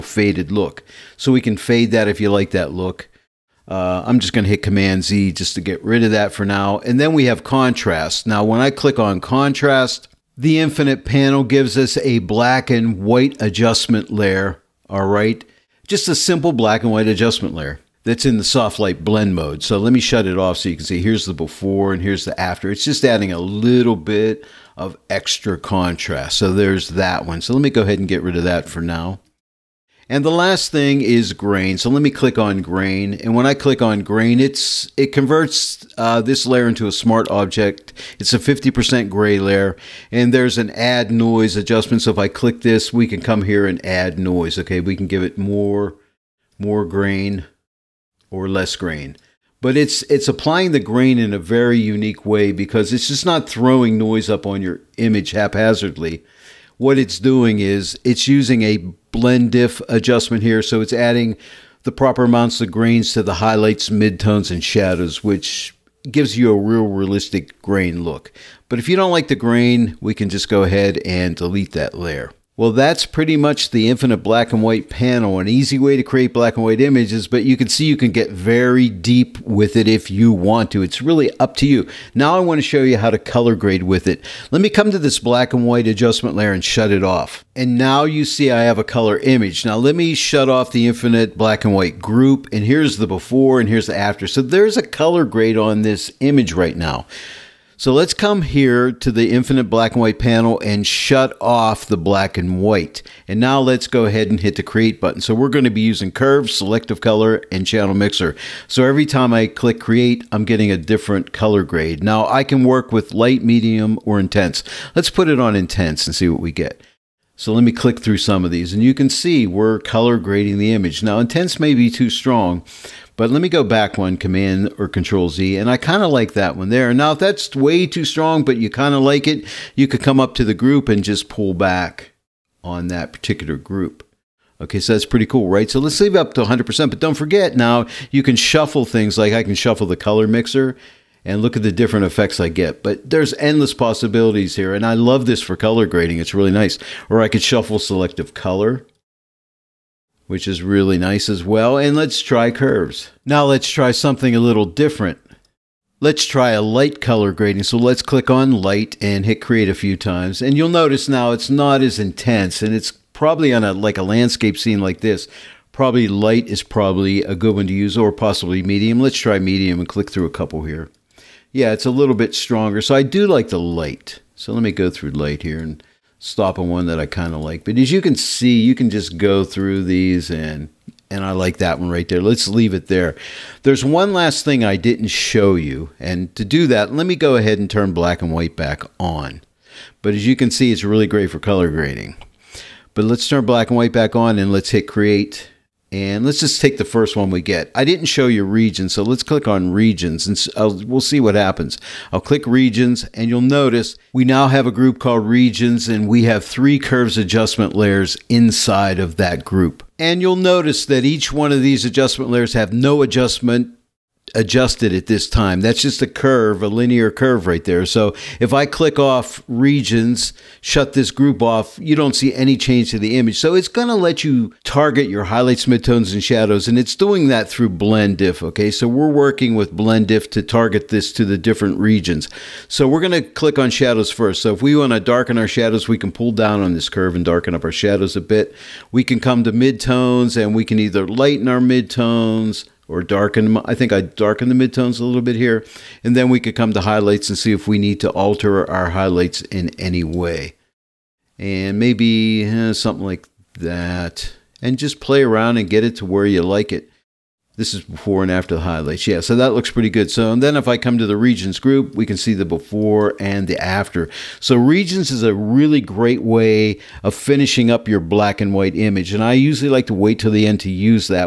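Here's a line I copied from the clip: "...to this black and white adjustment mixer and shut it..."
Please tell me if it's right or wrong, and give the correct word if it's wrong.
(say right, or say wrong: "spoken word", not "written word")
wrong: "layer", not "mixer".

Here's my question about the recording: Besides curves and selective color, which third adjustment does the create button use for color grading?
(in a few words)
Channel mixer.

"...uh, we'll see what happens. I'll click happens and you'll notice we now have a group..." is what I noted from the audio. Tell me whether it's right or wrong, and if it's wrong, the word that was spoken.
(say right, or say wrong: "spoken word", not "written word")
wrong: "regions", not "happens".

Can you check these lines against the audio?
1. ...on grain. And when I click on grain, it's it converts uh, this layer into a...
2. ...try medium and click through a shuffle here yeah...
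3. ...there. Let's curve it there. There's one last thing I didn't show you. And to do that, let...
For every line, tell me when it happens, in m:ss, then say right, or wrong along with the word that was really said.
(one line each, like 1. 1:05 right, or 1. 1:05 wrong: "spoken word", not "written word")
1. 0:32 right
2. 2:49 wrong: "couple", not "shuffle"
3. 3:02 wrong: "leave", not "curve".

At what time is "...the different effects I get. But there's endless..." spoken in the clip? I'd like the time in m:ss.
2:21.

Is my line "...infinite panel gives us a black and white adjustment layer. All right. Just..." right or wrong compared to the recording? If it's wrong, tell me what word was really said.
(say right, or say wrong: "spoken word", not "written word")
right.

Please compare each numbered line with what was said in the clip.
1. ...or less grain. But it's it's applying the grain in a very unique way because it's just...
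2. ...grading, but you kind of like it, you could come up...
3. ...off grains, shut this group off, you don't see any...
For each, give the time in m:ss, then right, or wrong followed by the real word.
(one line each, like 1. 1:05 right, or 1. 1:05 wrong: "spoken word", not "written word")
1. 0:48 right
2. 2:08 wrong: "strong", not "grading"
3. 3:38 wrong: "regions", not "grains".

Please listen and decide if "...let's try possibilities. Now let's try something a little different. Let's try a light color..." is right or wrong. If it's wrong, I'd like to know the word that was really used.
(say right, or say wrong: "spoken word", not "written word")
wrong: "curves", not "possibilities".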